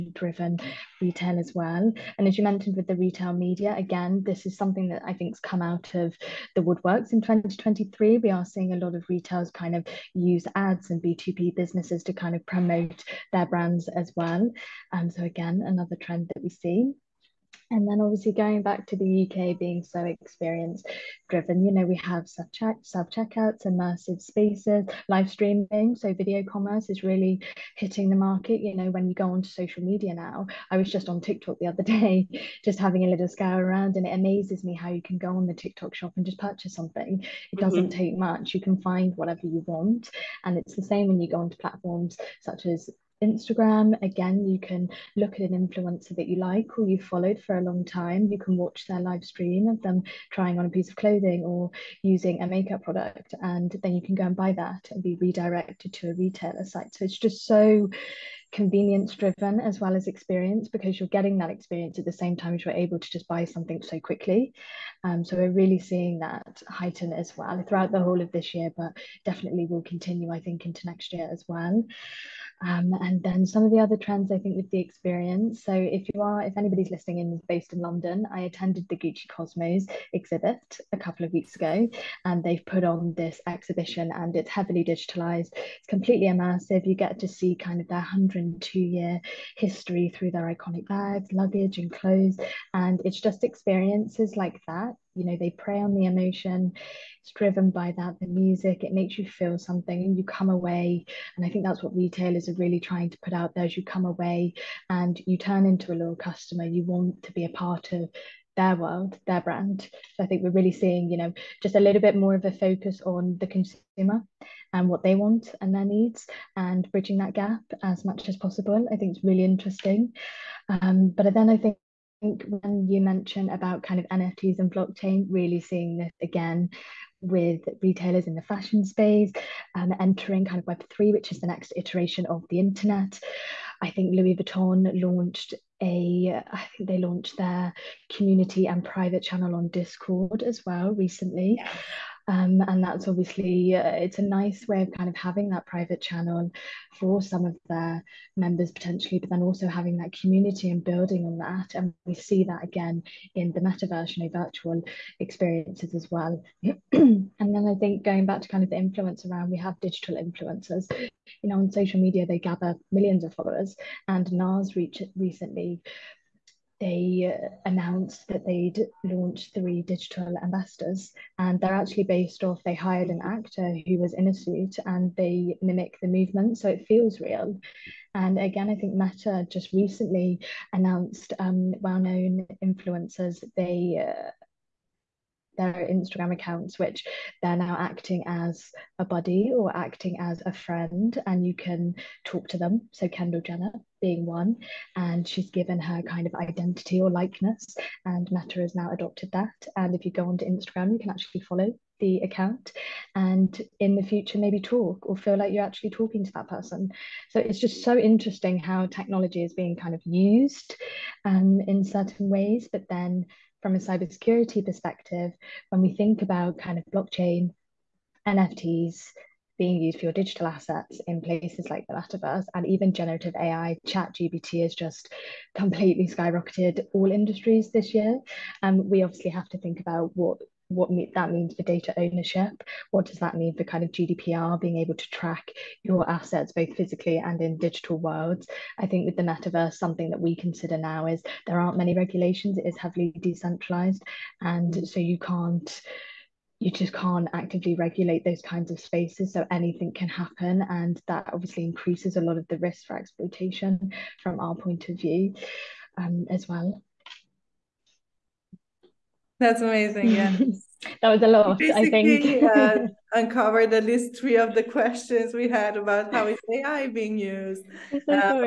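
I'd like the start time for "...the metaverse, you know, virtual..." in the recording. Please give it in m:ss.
2:33.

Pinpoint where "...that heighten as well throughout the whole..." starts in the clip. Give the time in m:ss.
1:06.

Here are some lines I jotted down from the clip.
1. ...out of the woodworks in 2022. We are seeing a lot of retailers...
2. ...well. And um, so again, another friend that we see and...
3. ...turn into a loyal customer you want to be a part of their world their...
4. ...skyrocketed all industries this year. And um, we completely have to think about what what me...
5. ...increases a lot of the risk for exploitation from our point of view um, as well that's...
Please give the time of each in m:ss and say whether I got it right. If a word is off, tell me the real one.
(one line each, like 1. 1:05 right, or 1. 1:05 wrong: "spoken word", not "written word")
1. 0:05 wrong: "2023", not "2022"
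2. 0:14 wrong: "trend", not "friend"
3. 1:45 right
4. 3:46 wrong: "obviously", not "completely"
5. 4:11 right.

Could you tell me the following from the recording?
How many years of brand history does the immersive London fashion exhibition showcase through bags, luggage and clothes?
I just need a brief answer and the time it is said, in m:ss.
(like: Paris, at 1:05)
102, at 1:27.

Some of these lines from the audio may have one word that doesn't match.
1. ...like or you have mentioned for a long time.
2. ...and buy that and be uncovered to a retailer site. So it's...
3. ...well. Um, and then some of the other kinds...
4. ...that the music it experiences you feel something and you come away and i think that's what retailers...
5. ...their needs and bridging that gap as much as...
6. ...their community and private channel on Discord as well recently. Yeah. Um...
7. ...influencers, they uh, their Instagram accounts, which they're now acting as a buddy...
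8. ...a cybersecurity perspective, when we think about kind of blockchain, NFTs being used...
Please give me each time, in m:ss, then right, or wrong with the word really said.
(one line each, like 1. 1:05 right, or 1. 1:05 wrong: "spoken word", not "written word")
1. 0:46 wrong: "followed", not "mentioned"
2. 0:54 wrong: "redirected", not "uncovered"
3. 1:11 wrong: "trends", not "kinds"
4. 1:37 wrong: "makes", not "experiences"
5. 1:55 right
6. 2:17 right
7. 3:02 right
8. 3:33 right.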